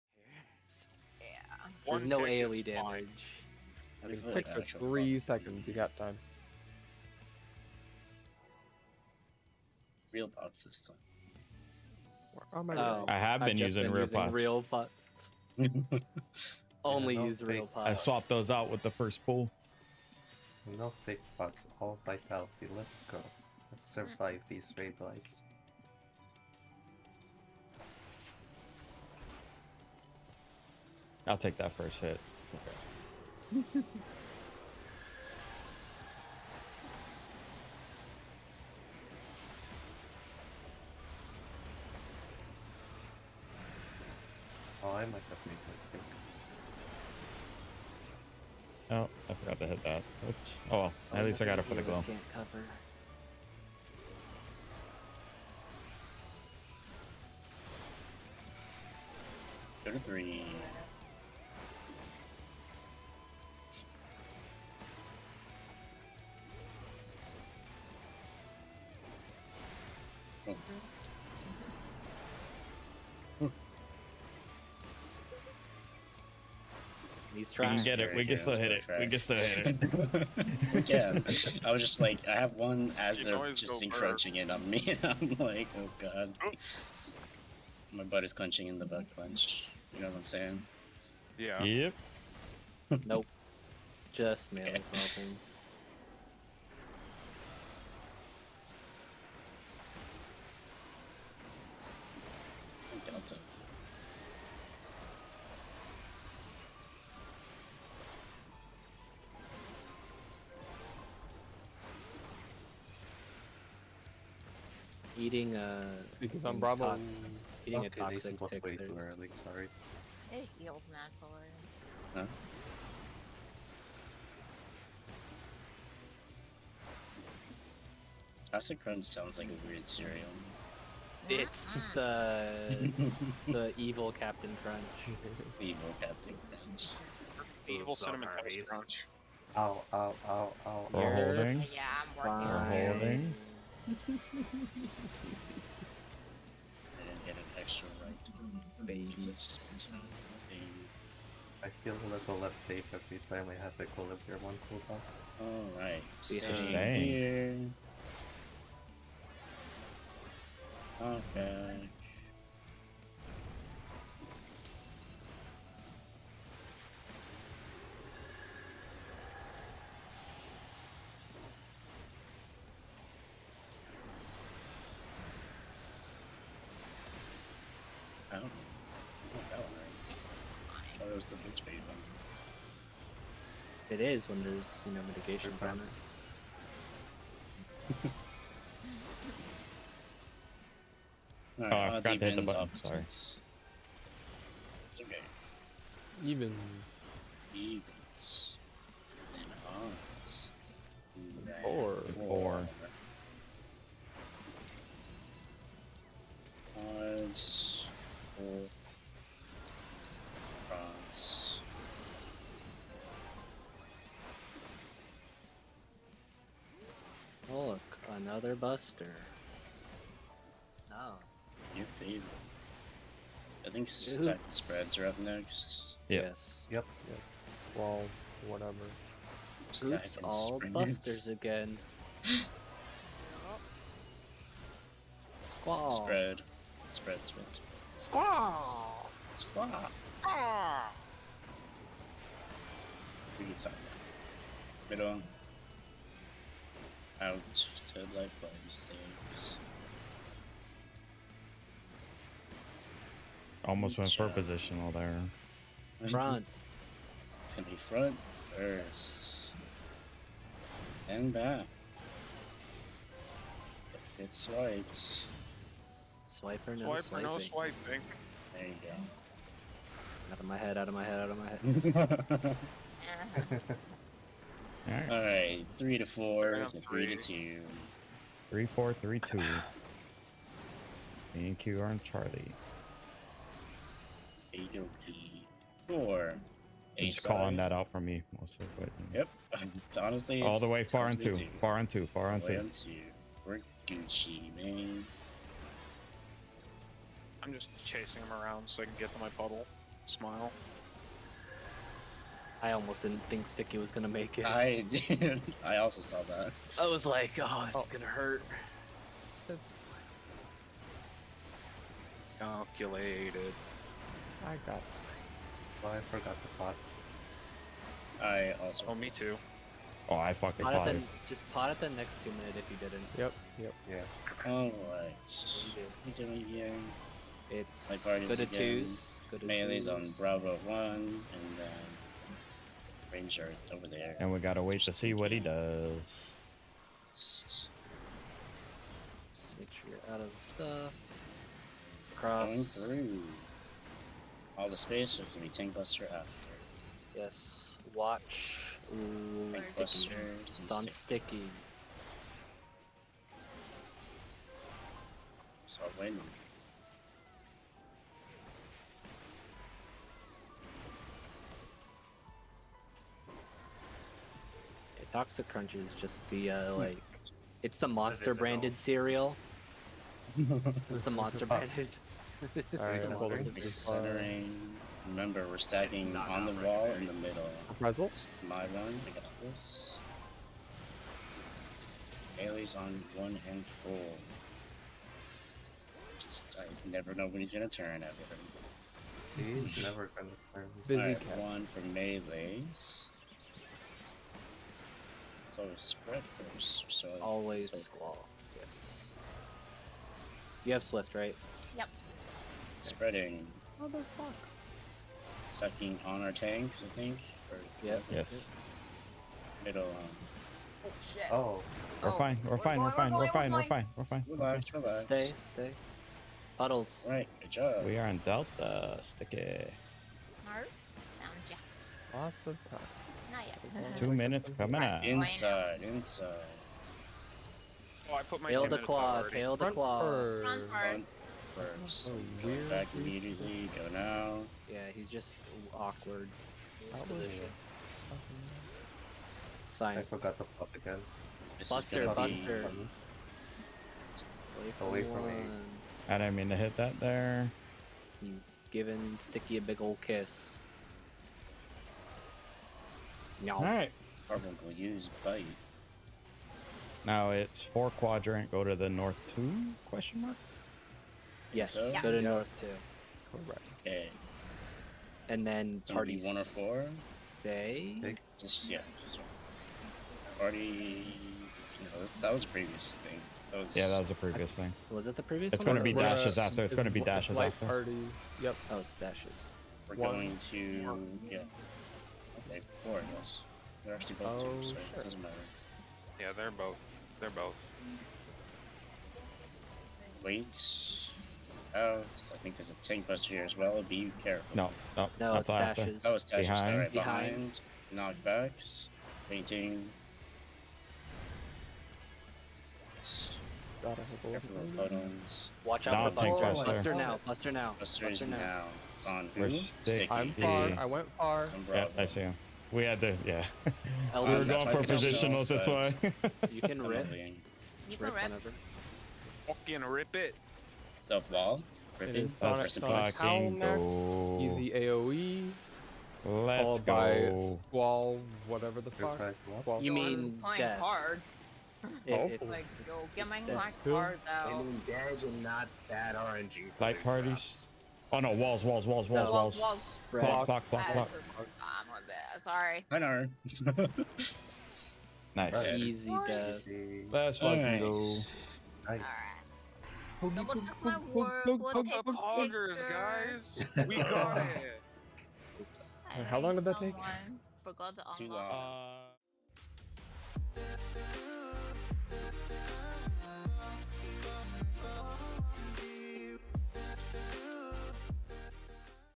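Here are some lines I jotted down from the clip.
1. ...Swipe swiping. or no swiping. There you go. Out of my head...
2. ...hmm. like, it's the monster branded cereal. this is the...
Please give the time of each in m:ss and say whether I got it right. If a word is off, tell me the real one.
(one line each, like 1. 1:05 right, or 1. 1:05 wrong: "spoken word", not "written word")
1. 4:26 right
2. 6:06 right.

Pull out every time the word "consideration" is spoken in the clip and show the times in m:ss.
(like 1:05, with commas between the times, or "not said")
not said.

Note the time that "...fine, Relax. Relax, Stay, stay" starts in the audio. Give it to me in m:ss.
6:54.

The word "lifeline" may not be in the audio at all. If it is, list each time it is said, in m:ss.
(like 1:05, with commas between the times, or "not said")
4:07.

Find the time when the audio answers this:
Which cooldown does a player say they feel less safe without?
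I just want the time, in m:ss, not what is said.
2:33.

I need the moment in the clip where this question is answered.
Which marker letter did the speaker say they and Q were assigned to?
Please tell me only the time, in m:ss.
4:41.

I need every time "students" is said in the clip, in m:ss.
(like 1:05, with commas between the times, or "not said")
not said.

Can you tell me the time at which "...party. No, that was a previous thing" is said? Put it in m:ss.
7:50.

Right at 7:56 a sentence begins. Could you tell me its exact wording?
It's, it's going to be dashes after.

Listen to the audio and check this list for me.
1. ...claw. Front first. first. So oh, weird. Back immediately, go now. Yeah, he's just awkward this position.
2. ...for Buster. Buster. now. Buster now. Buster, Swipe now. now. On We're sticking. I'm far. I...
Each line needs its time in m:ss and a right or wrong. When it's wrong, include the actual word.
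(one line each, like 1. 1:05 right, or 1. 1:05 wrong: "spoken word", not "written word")
1. 7:09 right
2. 8:26 wrong: "Buster", not "Swipe".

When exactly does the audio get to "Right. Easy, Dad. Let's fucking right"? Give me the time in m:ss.
9:05.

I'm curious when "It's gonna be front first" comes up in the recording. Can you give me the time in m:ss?
4:17.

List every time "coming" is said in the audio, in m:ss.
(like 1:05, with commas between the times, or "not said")
7:04.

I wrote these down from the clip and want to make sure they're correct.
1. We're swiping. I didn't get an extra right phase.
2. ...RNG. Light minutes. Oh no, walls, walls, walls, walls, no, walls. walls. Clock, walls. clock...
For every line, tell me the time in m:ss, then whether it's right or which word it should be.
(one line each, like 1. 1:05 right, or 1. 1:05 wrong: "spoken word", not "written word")
1. 2:22 wrong: "holding", not "swiping"
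2. 8:56 wrong: "parties", not "minutes".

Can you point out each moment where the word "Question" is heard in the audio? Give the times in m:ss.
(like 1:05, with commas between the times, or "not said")
7:39.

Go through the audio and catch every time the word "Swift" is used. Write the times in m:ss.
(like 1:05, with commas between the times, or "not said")
6:40.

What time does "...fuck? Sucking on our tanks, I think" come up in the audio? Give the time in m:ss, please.
6:44.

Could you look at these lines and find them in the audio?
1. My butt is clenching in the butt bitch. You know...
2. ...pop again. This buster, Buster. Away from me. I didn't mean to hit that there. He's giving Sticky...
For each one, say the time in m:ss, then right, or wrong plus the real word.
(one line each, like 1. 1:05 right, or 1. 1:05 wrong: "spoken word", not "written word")
1. 1:27 wrong: "clench", not "bitch"
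2. 7:20 right.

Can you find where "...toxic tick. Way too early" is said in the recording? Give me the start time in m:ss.
1:57.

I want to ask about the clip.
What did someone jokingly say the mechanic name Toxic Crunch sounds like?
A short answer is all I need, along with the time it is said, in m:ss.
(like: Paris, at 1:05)
a weird cereal, at 2:09.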